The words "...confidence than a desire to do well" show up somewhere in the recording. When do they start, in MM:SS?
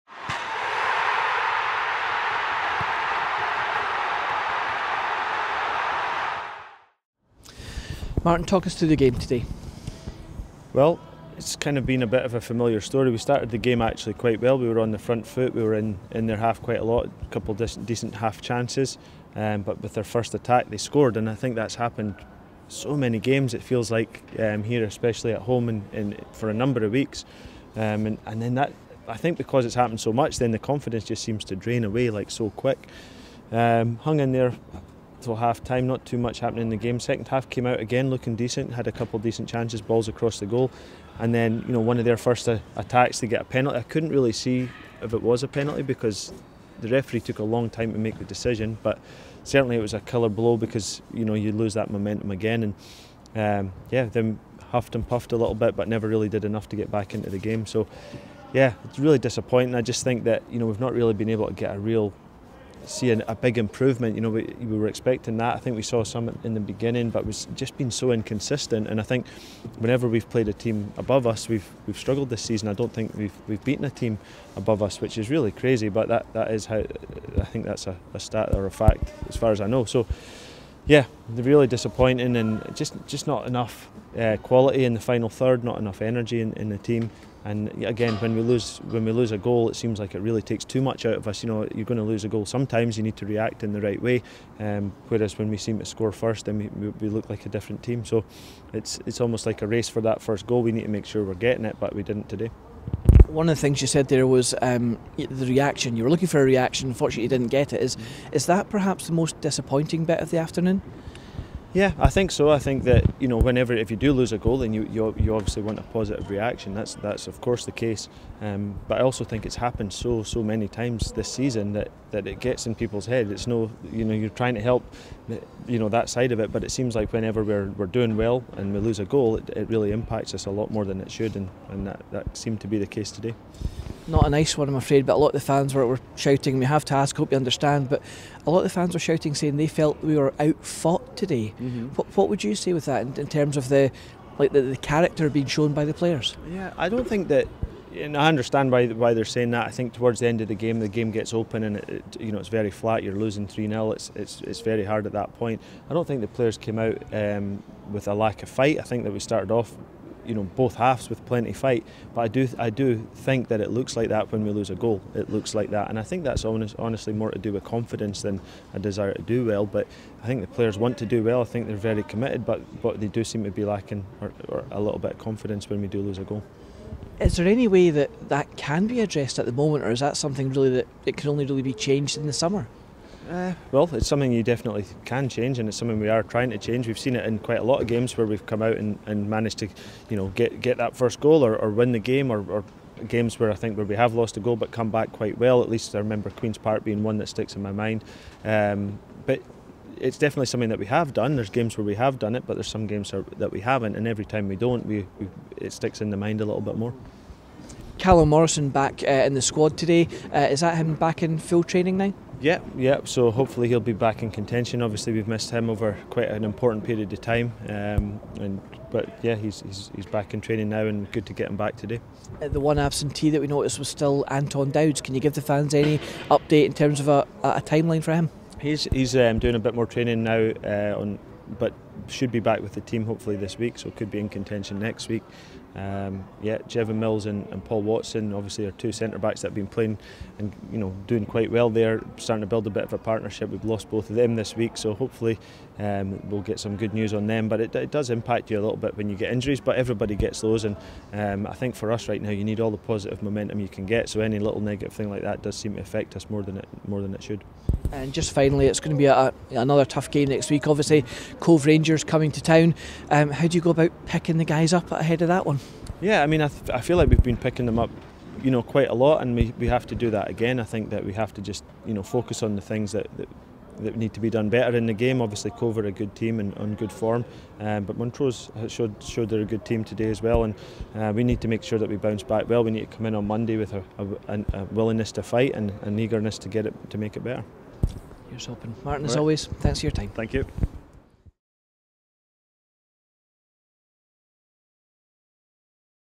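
02:47.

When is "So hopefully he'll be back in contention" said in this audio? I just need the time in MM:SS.
03:33.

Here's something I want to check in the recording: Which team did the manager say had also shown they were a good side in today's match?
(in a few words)
Montrose.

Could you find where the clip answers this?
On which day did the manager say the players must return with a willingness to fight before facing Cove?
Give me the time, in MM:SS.
04:43.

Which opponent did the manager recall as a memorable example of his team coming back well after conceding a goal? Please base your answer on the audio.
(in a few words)
Queens Park.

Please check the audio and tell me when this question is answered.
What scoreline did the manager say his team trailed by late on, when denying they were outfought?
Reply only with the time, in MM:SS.
02:33.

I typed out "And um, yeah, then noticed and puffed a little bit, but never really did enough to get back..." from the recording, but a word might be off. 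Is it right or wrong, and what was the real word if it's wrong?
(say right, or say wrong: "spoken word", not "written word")
wrong: "huffed", not "noticed".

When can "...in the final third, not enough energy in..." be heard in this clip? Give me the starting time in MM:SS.
01:24.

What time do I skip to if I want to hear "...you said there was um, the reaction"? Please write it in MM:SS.
01:43.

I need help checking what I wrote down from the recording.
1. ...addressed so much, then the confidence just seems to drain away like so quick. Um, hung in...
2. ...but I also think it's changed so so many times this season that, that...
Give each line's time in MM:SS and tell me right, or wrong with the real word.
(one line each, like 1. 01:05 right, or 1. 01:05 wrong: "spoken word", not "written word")
1. 00:29 wrong: "happened", not "addressed"
2. 01:58 wrong: "happened", not "changed".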